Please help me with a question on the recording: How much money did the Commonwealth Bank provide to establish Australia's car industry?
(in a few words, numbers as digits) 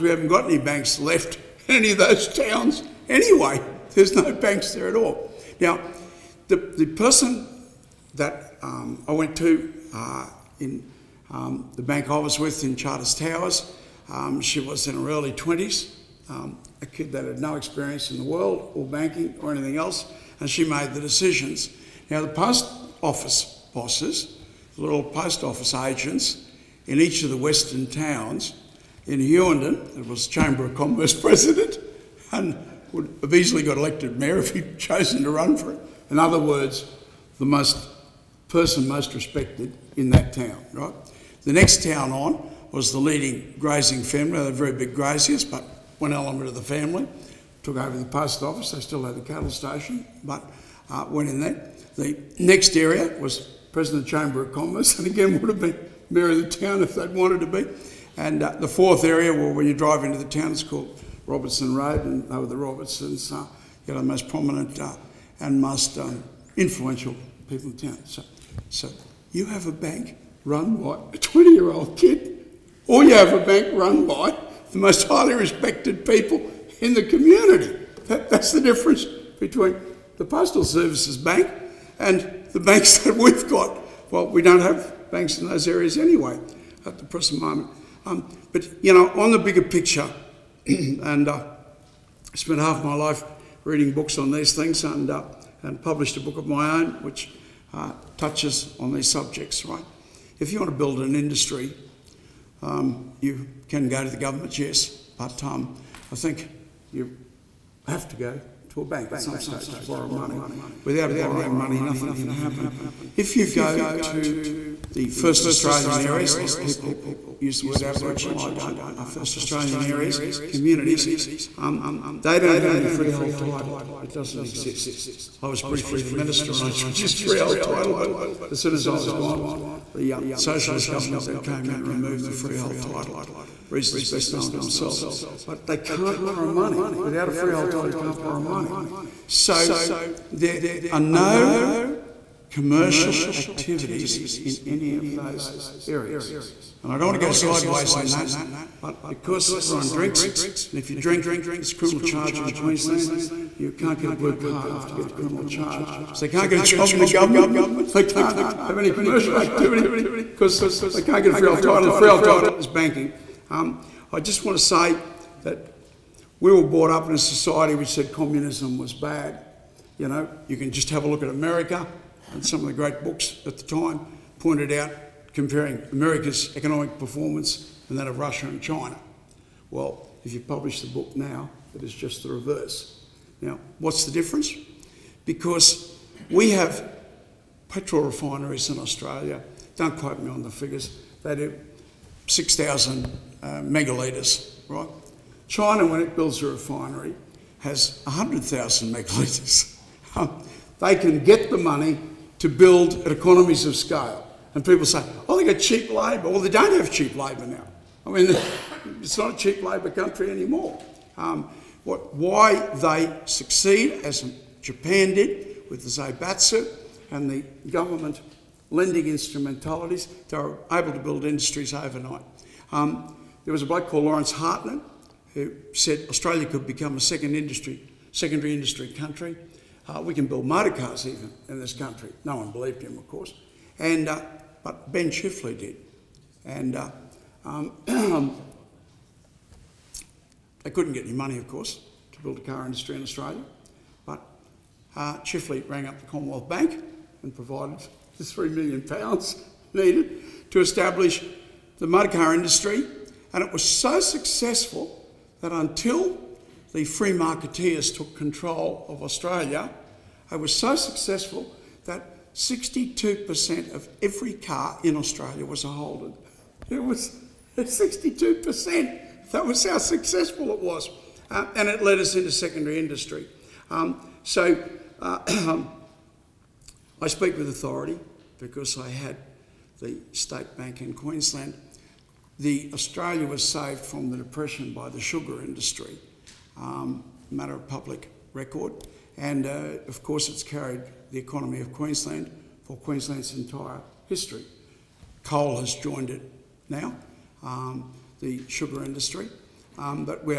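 3 million pounds.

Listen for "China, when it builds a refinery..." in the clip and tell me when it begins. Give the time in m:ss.
3:15.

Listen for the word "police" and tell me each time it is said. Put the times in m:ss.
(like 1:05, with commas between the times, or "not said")
not said.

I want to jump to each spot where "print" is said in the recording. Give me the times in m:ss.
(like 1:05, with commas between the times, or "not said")
not said.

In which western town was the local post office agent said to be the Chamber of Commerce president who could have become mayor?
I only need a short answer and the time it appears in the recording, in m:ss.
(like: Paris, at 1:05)
Hughenden, at 0:29.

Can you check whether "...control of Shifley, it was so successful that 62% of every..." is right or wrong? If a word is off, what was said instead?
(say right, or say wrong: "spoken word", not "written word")
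wrong: "Australia", not "Shifley".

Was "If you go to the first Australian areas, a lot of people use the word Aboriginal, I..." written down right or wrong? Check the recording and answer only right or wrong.
right.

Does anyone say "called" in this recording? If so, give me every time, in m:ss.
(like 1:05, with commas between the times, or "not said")
1:00, 3:43.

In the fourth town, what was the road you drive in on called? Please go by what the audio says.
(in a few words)
Robertson Road.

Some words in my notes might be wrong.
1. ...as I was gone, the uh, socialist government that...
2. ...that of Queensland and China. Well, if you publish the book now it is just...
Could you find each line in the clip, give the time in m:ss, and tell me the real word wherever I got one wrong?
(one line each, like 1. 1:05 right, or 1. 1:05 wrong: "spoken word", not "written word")
1. 2:08 right
2. 2:57 wrong: "Russia", not "Queensland".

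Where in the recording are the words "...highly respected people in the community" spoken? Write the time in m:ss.
1:15.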